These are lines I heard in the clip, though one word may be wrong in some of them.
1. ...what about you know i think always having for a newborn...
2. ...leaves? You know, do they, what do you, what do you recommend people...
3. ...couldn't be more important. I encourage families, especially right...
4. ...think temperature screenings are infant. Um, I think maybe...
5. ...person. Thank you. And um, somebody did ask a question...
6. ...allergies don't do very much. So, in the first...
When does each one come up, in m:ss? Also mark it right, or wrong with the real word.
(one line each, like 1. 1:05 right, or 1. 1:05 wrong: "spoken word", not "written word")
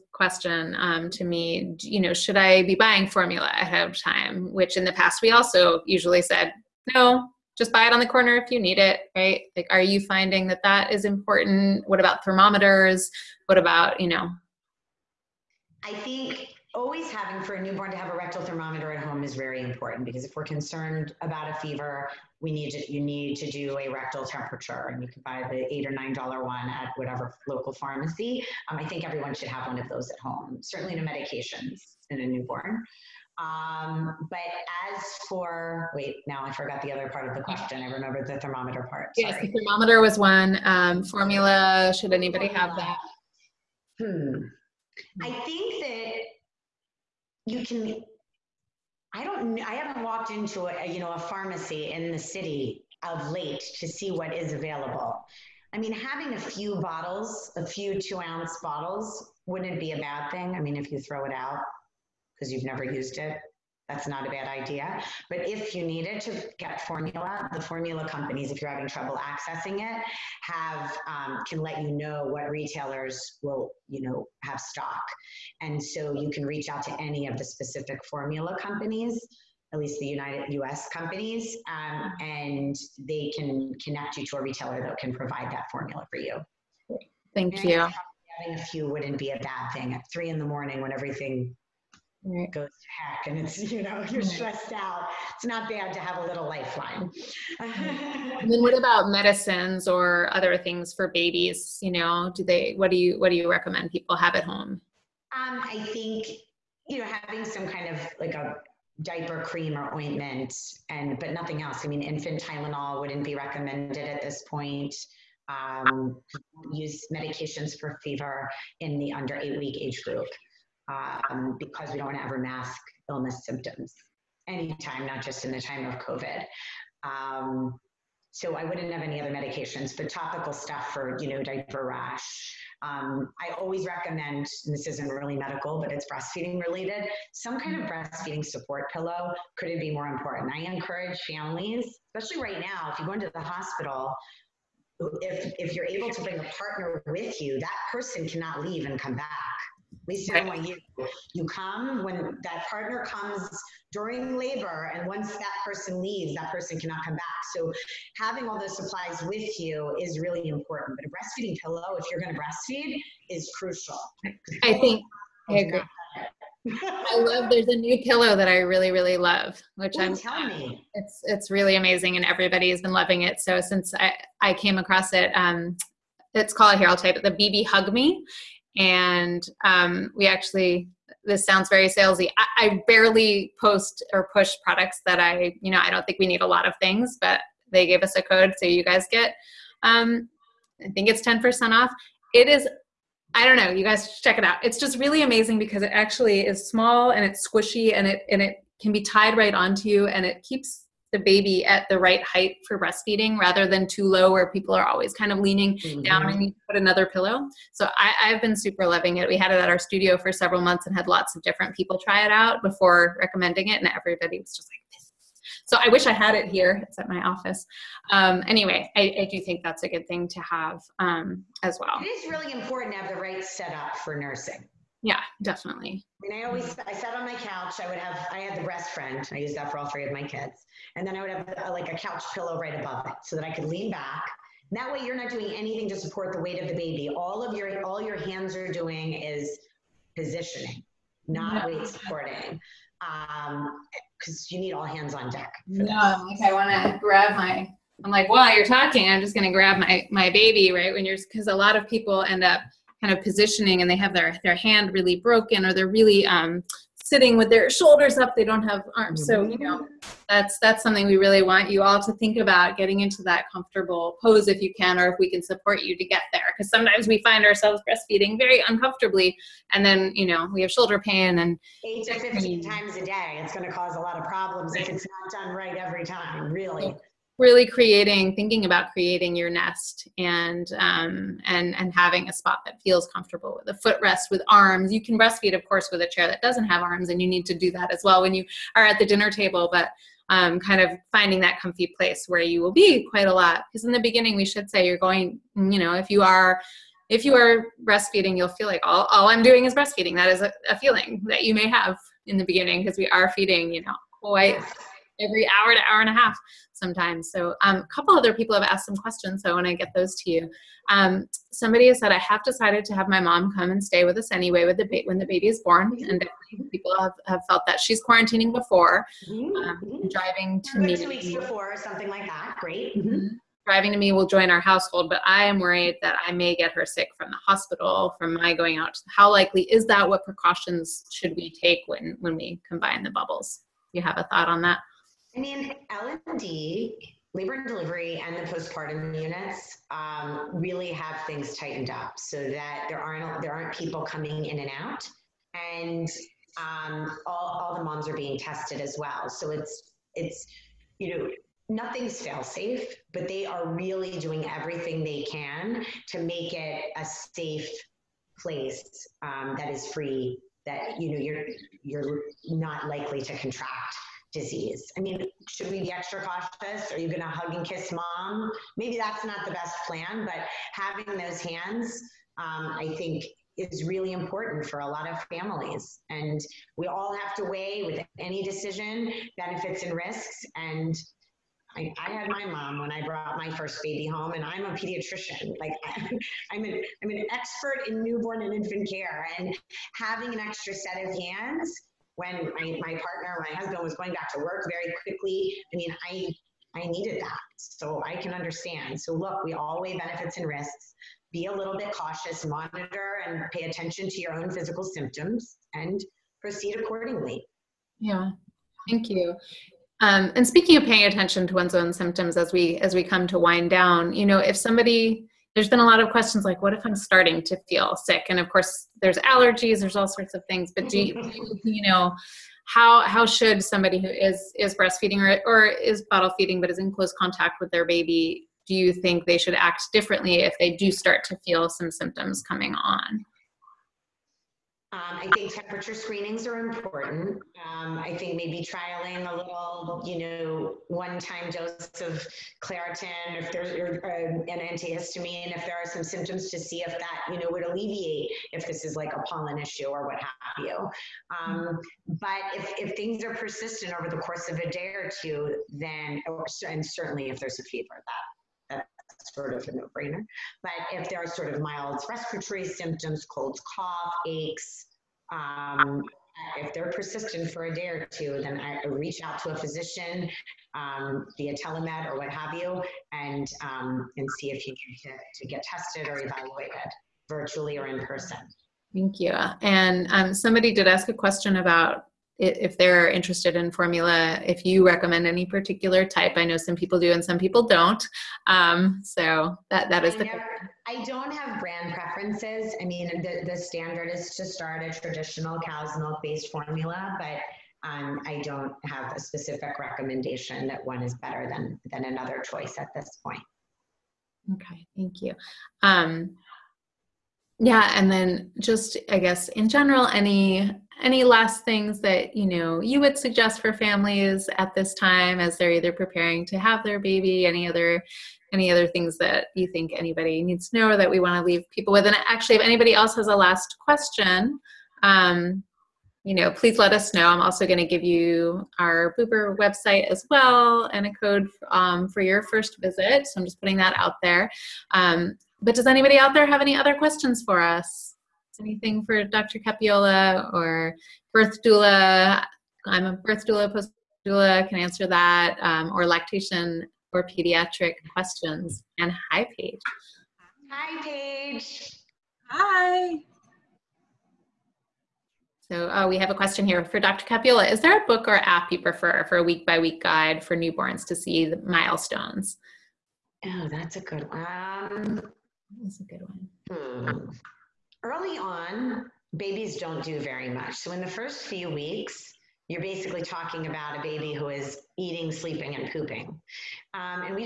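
1. 0:13 right
2. 1:41 wrong: "babies", not "leaves"
3. 2:19 right
4. 7:15 wrong: "important", not "infant"
5. 7:58 right
6. 9:29 wrong: "babies", not "allergies".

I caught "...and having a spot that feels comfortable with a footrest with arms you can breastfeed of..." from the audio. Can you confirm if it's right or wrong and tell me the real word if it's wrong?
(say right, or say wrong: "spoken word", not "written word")
right.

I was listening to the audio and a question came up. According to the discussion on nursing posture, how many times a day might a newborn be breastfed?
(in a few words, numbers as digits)
8 to 15.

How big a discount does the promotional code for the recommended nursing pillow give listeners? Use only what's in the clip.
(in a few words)
10%.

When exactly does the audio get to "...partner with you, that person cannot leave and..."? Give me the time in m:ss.
2:26.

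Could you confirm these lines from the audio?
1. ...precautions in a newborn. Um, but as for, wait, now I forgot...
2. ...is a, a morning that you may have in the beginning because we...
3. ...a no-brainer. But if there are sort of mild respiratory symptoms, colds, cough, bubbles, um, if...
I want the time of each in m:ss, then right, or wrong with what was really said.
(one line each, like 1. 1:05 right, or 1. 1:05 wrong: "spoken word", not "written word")
1. 0:31 wrong: "medications", not "precautions"
2. 5:00 wrong: "feeling", not "morning"
3. 7:39 wrong: "aches", not "bubbles".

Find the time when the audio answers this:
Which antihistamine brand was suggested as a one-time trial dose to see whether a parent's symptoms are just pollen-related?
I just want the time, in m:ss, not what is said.
7:22.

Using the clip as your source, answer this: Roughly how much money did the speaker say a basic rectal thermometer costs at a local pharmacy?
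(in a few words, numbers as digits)
8 or 9 dollars.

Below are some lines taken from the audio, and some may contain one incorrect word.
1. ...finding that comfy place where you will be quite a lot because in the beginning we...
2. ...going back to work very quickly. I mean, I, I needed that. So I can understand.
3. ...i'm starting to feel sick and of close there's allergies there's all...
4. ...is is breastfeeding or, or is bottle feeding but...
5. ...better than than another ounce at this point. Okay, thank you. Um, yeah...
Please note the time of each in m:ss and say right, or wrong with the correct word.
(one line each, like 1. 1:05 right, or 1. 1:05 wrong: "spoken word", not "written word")
1. 4:51 right
2. 6:33 right
3. 6:56 wrong: "course", not "close"
4. 7:04 right
5. 8:21 wrong: "choice", not "ounce".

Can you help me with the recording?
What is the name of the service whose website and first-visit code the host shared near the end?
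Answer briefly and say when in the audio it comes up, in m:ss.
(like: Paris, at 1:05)
Boober, at 8:49.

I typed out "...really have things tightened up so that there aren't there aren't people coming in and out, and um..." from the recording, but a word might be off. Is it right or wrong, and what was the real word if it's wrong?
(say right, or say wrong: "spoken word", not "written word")
right.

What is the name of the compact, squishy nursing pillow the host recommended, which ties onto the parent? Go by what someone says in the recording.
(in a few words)
BB Hug Me.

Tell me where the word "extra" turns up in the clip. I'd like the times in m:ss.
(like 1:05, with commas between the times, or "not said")
6:05, 6:30.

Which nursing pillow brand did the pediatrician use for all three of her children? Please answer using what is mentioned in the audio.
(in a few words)
Brest Friend.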